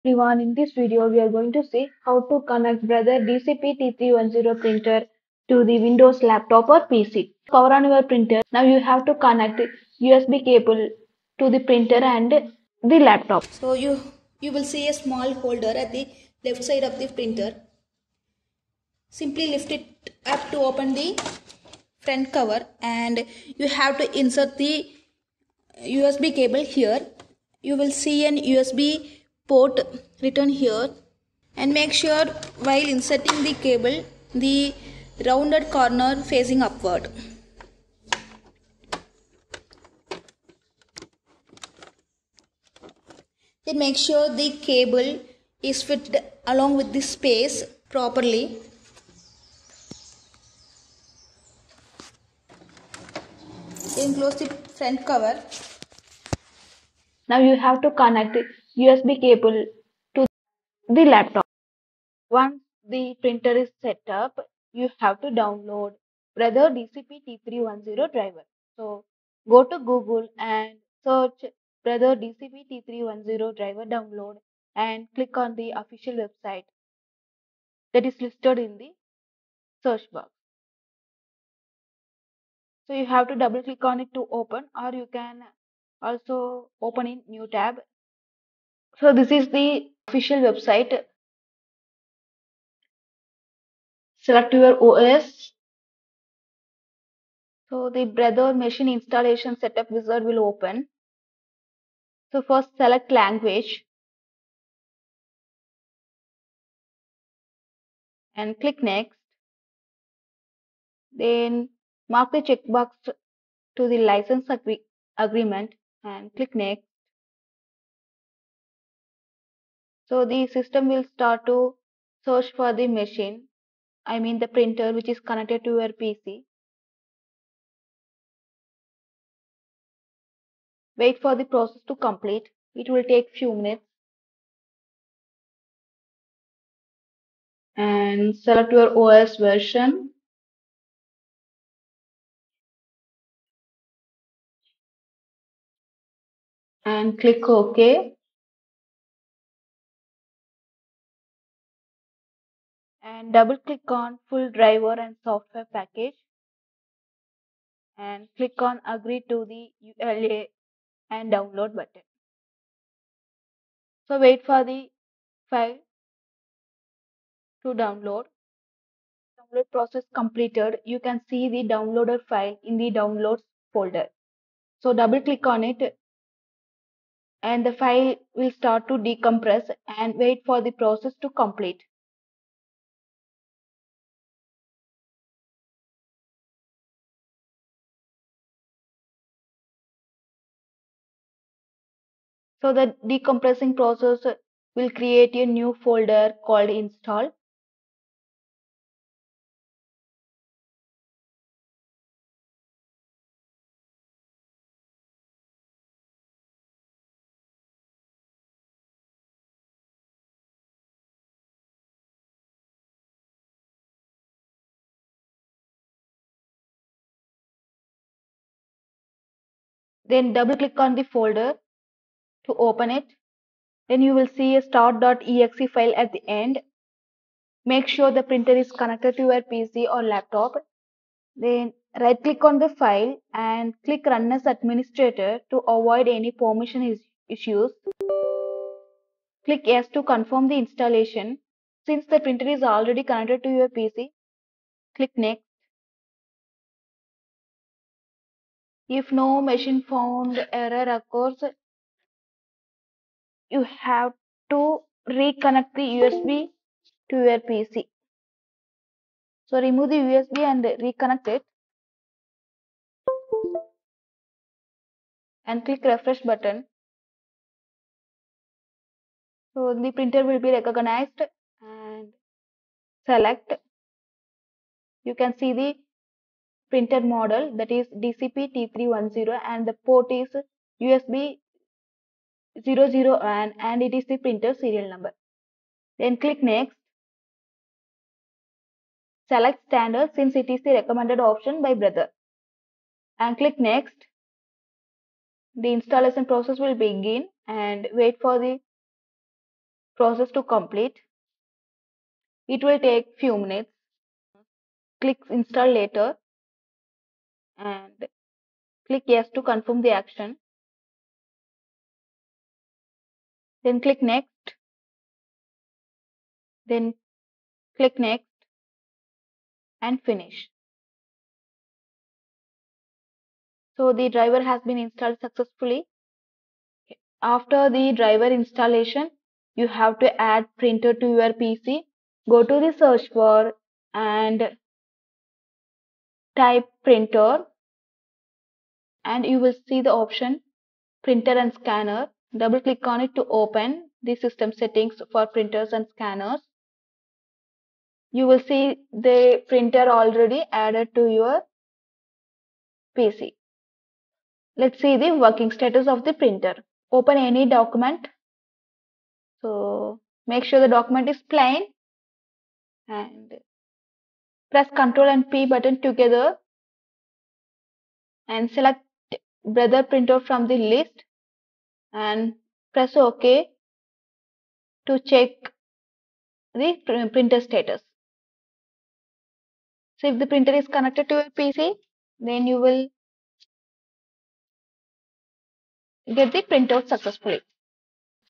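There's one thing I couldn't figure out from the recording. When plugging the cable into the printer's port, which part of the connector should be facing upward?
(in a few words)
rounded corner.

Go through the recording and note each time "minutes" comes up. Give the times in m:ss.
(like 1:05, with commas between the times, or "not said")
2:13, 5:03.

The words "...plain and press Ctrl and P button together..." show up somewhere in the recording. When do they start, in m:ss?
6:01.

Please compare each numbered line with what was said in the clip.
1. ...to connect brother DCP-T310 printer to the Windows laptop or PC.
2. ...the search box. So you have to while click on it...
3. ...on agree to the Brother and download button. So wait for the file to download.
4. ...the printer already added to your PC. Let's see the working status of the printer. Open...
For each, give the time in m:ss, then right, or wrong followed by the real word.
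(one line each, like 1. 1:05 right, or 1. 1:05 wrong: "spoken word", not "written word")
1. 0:02 right
2. 1:18 wrong: "double", not "while"
3. 2:38 wrong: "EULA", not "Brother"
4. 5:48 right.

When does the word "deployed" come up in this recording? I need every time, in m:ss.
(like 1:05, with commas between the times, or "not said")
not said.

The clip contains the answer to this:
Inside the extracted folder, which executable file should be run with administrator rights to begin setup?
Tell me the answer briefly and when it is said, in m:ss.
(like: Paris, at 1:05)
start.exe, at 3:44.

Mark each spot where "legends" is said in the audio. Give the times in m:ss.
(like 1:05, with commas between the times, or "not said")
not said.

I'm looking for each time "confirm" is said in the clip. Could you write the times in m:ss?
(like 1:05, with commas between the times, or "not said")
4:00, 5:09.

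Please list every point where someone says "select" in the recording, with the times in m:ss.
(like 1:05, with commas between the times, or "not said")
1:34, 1:42, 2:18, 4:33, 4:49, 6:08.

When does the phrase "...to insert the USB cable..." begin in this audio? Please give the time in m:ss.
0:23.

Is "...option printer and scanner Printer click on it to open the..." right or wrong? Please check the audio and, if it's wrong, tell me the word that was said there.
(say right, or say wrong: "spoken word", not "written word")
wrong: "Double", not "Printer".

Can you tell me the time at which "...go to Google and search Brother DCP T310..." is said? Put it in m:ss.
1:09.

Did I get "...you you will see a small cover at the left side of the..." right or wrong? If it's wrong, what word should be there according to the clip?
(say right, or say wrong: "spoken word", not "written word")
wrong: "holder", not "cover".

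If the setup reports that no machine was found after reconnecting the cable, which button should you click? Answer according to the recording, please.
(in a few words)
refresh.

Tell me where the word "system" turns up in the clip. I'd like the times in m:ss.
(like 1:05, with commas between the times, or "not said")
2:00, 5:44.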